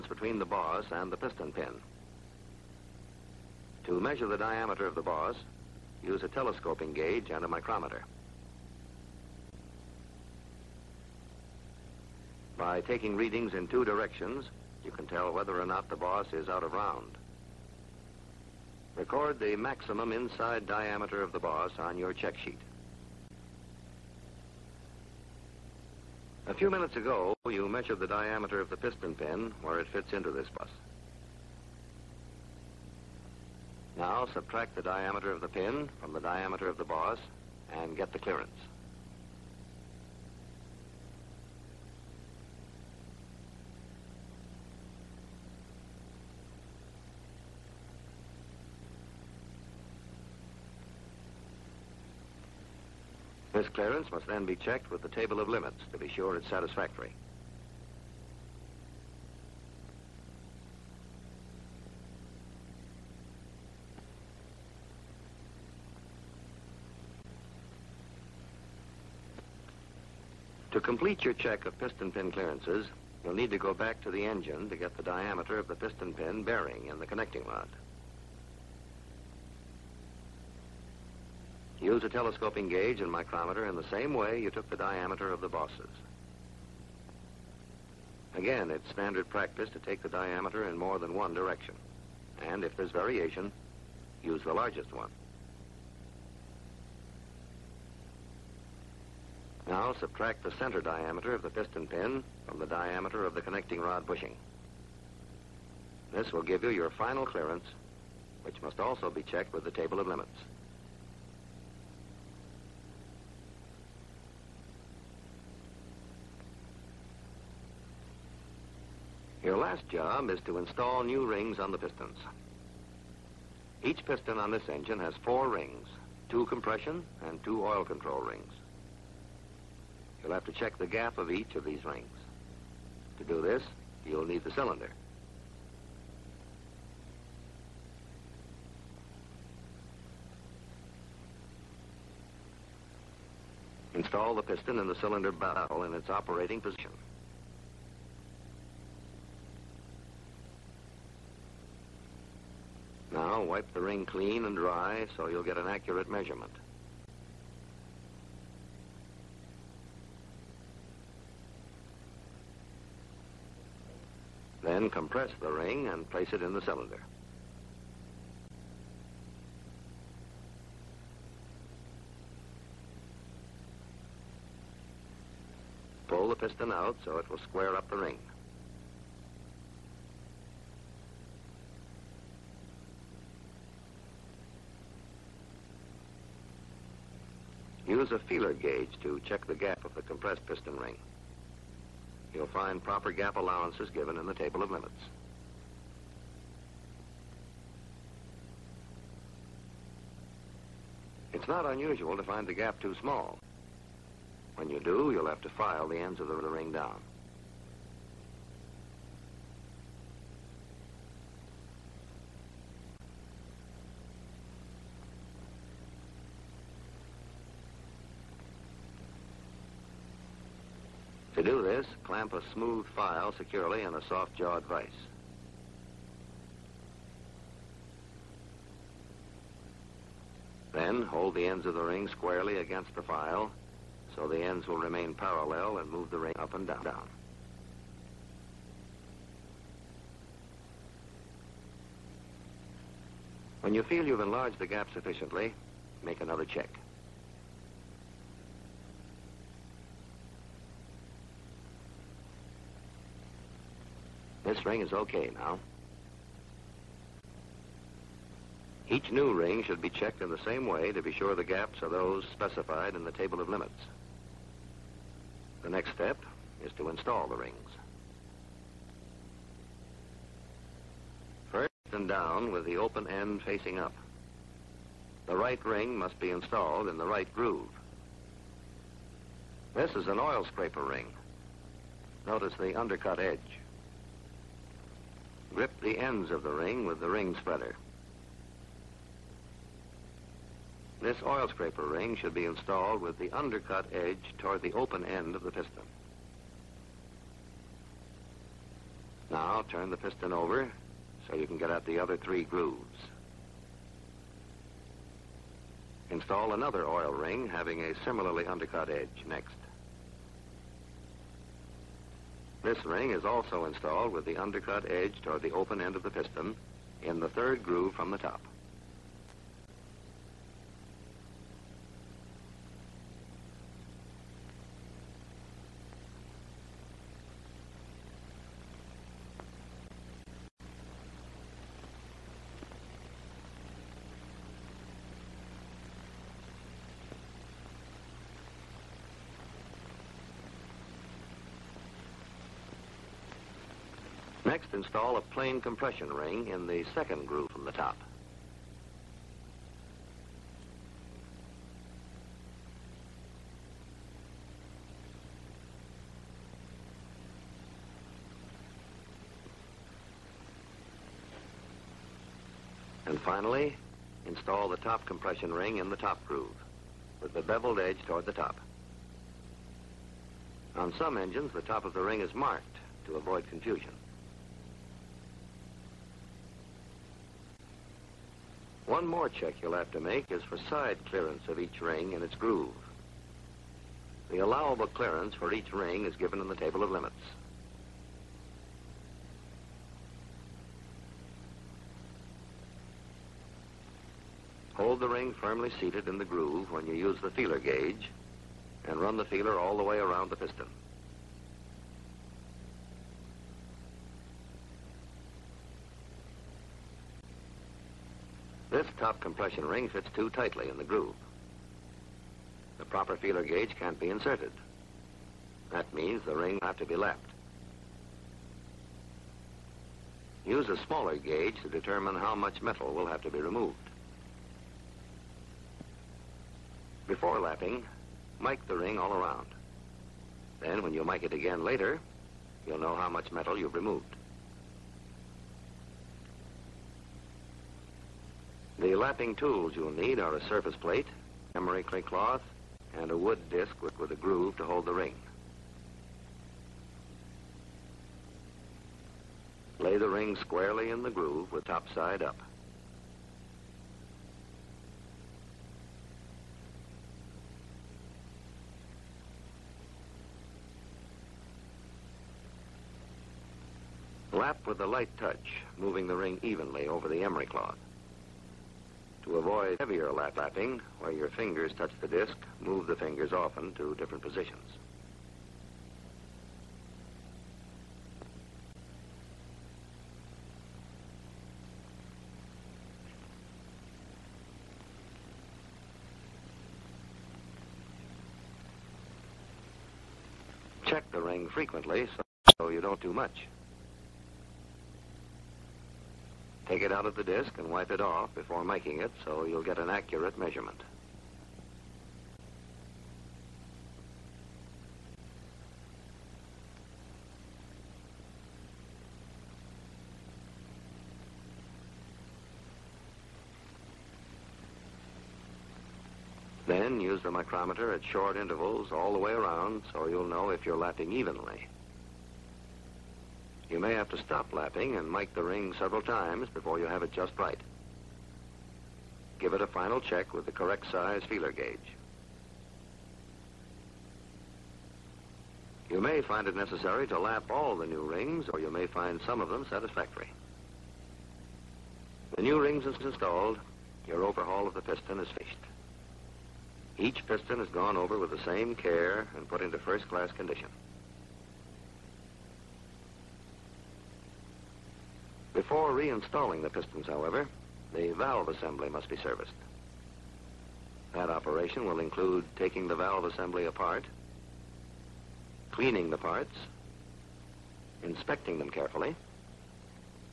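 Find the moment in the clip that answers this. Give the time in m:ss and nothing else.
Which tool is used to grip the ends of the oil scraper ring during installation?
4:47.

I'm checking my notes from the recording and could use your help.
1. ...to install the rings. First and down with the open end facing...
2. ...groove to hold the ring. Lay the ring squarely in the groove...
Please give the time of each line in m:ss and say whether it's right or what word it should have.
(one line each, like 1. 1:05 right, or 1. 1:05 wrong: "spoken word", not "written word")
1. 4:26 right
2. 7:24 right.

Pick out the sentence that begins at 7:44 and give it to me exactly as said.
Lap with a light touch, moving the ring evenly over the emery cloth.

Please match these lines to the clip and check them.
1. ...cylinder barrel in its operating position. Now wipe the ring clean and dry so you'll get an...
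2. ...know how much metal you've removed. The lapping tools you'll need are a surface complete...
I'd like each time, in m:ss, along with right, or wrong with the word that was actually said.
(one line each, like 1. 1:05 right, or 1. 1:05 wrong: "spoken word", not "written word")
1. 2:24 right
2. 7:12 wrong: "plate", not "complete".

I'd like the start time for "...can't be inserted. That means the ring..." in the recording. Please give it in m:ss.
6:53.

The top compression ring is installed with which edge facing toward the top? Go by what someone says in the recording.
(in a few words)
beveled edge.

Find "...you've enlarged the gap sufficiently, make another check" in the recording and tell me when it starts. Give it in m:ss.
4:04.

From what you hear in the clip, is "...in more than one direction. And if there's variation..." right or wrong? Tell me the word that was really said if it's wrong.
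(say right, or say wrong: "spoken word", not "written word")
right.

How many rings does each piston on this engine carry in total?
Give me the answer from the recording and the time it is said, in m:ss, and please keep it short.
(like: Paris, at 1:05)
4, at 2:05.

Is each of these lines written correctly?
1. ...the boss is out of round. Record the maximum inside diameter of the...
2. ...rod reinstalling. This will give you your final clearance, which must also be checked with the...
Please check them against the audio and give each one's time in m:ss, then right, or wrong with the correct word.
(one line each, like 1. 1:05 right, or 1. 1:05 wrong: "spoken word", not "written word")
1. 0:15 right
2. 1:43 wrong: "bushing", not "reinstalling".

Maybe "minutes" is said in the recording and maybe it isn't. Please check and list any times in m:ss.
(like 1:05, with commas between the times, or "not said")
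0:26.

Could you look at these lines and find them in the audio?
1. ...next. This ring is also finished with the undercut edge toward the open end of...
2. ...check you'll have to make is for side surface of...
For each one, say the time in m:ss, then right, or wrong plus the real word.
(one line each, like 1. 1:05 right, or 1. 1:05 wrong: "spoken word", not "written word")
1. 5:09 wrong: "installed", not "finished"
2. 6:19 wrong: "clearance", not "surface".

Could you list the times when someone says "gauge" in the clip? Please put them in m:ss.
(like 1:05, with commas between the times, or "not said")
0:06, 1:22, 3:08, 6:37, 6:53, 7:01, 8:51.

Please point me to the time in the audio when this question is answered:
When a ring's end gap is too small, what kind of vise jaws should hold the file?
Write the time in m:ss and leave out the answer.
3:44.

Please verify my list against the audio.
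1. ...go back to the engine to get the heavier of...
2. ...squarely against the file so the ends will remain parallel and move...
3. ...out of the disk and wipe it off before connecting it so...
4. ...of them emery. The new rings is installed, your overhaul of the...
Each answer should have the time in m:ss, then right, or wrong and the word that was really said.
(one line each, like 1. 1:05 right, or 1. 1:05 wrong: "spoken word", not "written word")
1. 1:13 wrong: "diameter", not "heavier"
2. 3:52 right
3. 8:16 wrong: "miking", not "connecting"
4. 8:59 wrong: "satisfactory", not "emery".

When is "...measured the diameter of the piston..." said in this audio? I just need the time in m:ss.
0:27.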